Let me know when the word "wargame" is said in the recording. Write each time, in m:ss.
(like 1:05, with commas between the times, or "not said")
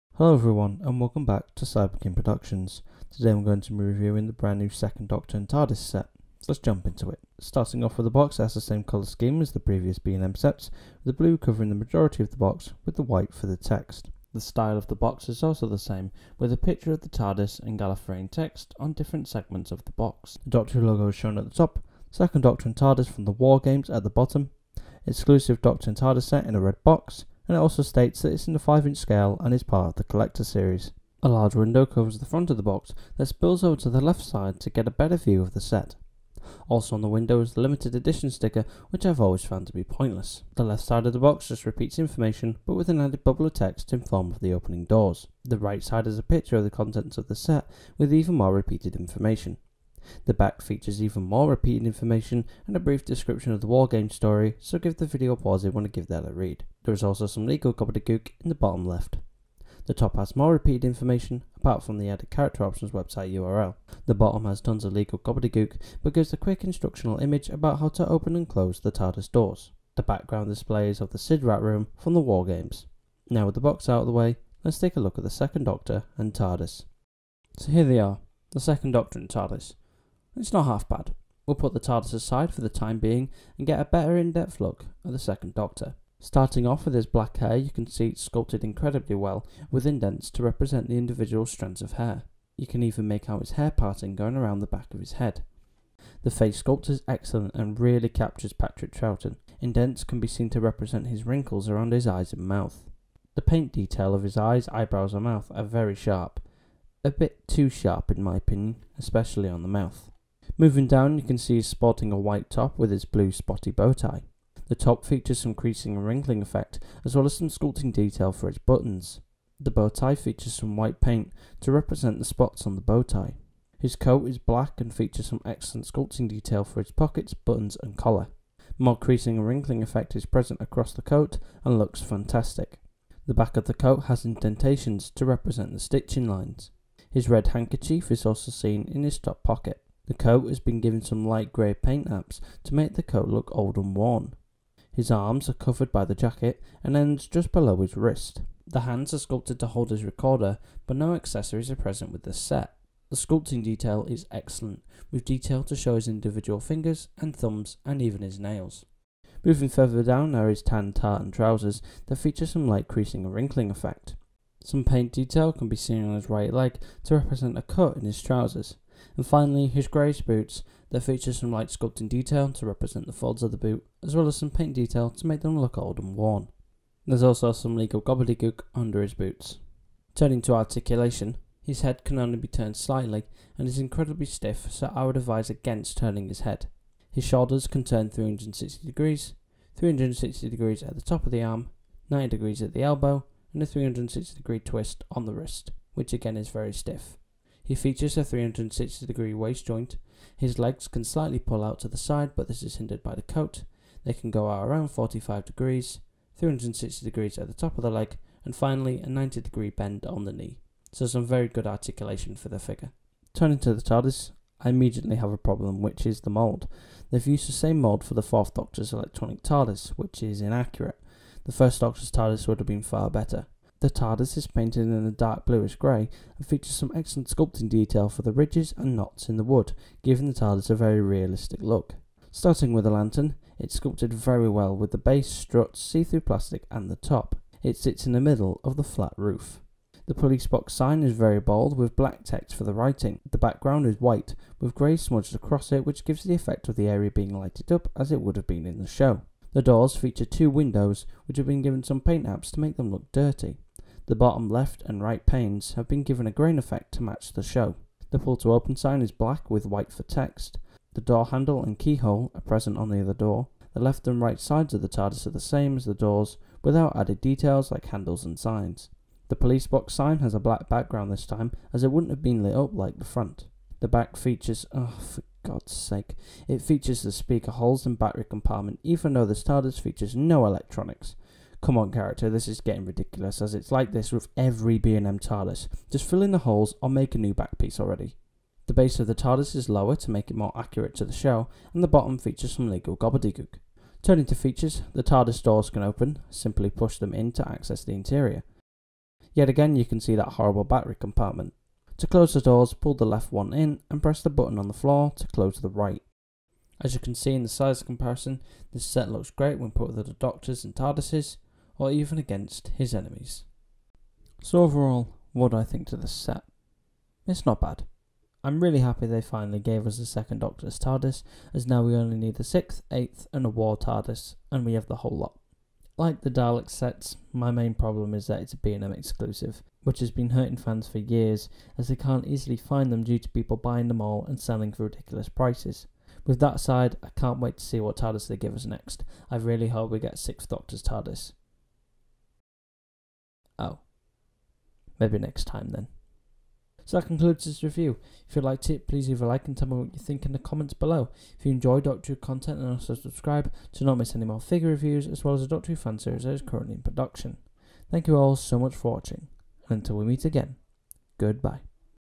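0:53, 1:12.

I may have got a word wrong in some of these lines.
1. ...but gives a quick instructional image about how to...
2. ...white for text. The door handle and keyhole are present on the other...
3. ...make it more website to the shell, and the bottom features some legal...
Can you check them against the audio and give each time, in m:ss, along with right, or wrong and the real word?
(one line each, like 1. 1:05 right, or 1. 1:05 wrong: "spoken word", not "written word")
1. 1:06 right
2. 4:19 right
3. 4:50 wrong: "accurate", not "website".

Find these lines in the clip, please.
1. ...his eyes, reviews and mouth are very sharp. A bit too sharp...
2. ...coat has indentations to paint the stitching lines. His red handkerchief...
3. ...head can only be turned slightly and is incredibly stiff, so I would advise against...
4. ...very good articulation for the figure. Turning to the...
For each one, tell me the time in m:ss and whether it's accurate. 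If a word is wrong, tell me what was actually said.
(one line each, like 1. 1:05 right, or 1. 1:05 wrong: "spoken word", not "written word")
1. 1:44 wrong: "eyebrows", not "reviews"
2. 2:13 wrong: "represent", not "paint"
3. 3:01 right
4. 3:31 right.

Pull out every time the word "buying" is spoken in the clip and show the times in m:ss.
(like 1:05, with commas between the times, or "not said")
5:33.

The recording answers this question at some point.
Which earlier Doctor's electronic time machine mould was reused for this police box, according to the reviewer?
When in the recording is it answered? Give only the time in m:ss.
3:38.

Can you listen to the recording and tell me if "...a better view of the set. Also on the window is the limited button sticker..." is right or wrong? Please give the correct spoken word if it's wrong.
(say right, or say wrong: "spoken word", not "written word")
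wrong: "edition", not "button".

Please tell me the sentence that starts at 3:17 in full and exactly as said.
He features a 360 degree waist joint.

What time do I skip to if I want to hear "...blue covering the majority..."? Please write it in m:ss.
0:11.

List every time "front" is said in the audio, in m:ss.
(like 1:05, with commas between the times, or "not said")
0:32, 4:33.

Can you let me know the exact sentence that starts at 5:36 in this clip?
With that aside, I can't wait to see what TARDIS they give us next.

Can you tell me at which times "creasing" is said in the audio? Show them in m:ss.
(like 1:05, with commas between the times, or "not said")
1:55, 2:08, 2:42.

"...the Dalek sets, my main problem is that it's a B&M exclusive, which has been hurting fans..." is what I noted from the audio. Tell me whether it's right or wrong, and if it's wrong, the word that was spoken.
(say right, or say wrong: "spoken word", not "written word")
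right.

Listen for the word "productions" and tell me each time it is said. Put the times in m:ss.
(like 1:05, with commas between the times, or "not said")
0:02, 5:56.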